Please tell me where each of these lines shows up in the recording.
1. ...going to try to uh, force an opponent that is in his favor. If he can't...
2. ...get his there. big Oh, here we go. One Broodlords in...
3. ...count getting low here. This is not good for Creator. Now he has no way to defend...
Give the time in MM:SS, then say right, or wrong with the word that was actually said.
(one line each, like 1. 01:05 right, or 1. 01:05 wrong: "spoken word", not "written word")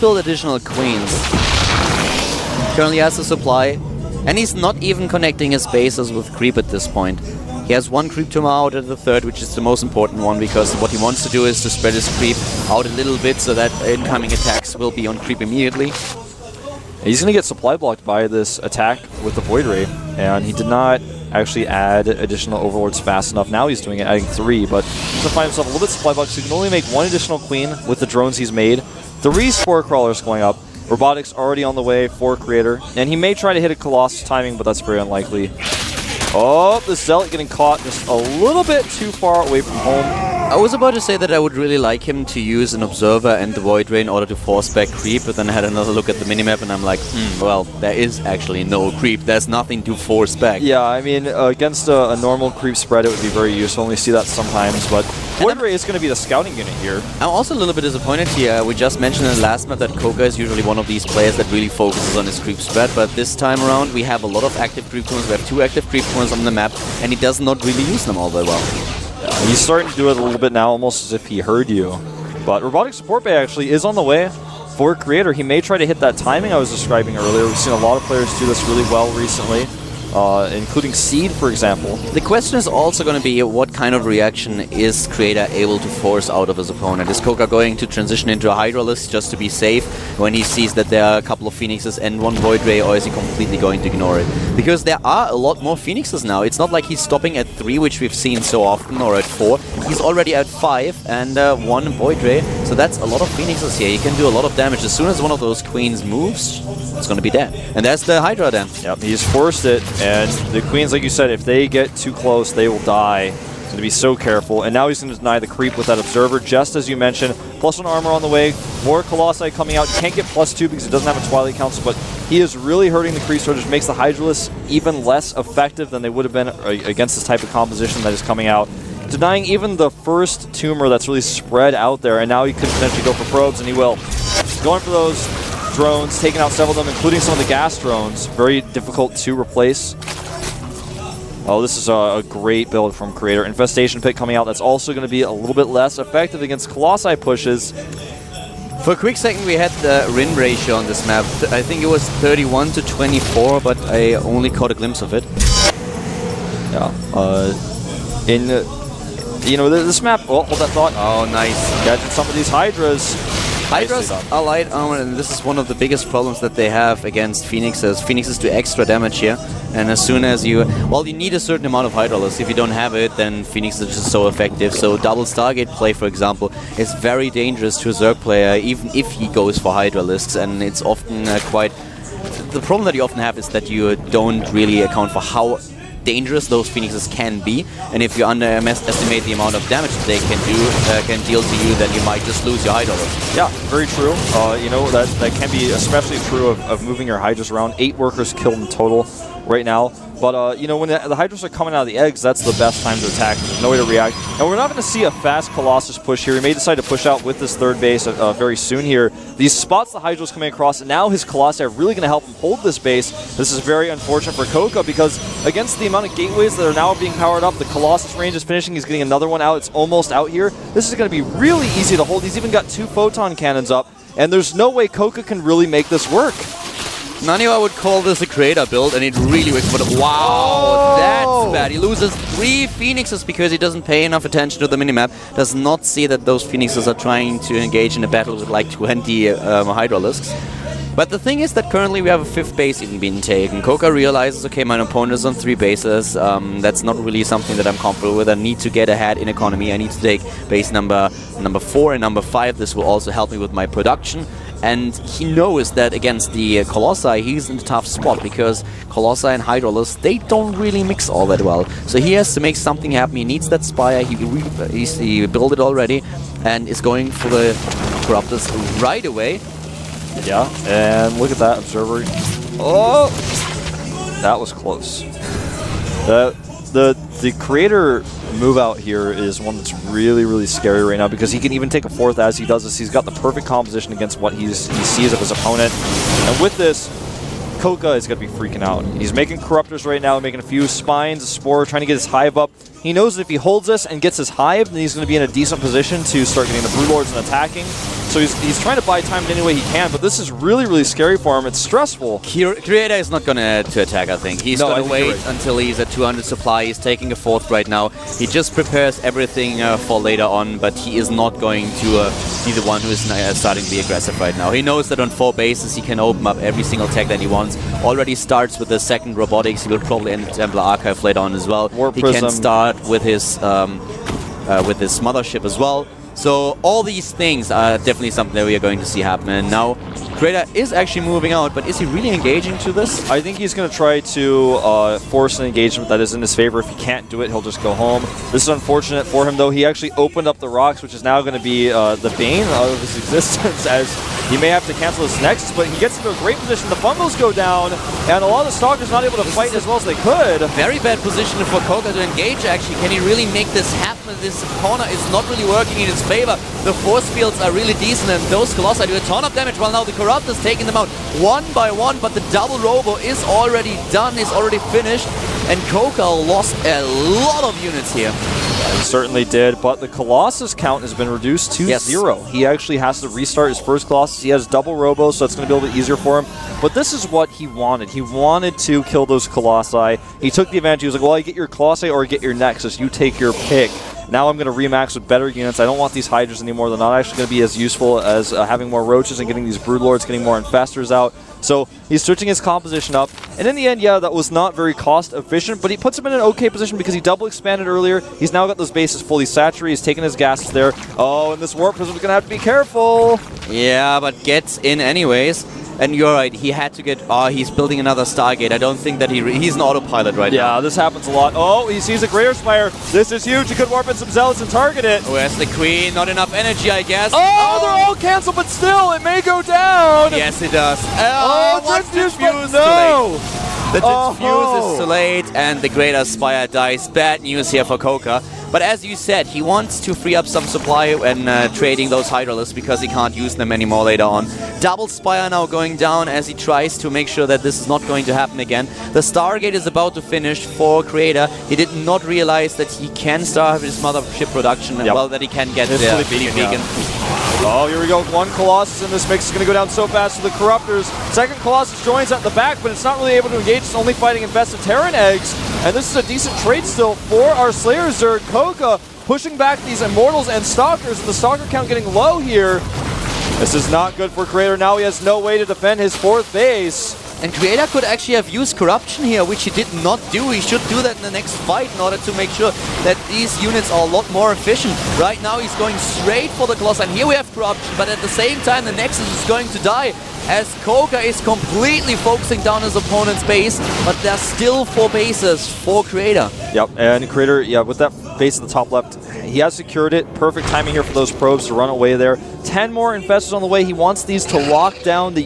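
1. 05:33 wrong: "engagement", not "opponent"
2. 07:25 wrong: "Colossus", not "Broodlords"
3. 07:41 right.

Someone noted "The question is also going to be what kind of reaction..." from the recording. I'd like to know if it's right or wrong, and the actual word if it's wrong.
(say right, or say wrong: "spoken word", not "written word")
right.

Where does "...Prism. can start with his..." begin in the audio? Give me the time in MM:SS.
05:22.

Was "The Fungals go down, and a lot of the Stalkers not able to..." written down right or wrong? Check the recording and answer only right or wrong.
right.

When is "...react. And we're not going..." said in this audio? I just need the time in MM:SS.
03:23.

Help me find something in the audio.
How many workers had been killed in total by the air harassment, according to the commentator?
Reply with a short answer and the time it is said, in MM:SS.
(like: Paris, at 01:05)
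8, at 03:17.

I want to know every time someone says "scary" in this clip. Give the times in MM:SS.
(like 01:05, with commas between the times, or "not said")
04:40, 05:00.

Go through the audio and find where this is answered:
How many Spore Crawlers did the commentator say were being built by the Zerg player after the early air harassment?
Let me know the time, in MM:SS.
00:29.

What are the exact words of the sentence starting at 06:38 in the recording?
He's now got those bases fully saturated.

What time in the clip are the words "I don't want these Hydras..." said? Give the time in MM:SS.
06:25.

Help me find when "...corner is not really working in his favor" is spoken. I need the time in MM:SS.
05:54.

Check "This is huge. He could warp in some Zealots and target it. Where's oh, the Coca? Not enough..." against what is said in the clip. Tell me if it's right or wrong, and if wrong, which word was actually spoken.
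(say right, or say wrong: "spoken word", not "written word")
wrong: "Queen", not "Coca".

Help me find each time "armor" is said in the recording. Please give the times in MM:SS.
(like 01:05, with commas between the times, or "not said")
01:57, 02:44.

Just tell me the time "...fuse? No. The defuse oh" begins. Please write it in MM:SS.
07:02.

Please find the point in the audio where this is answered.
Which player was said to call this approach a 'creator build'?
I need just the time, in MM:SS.
03:47.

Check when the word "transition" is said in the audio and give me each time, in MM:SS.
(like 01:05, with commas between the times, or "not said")
01:27.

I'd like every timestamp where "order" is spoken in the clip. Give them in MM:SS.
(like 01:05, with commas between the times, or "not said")
00:44, 07:51.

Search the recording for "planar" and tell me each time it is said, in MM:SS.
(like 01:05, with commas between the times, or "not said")
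not said.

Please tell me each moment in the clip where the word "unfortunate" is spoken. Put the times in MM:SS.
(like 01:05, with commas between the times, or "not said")
03:33, 05:38.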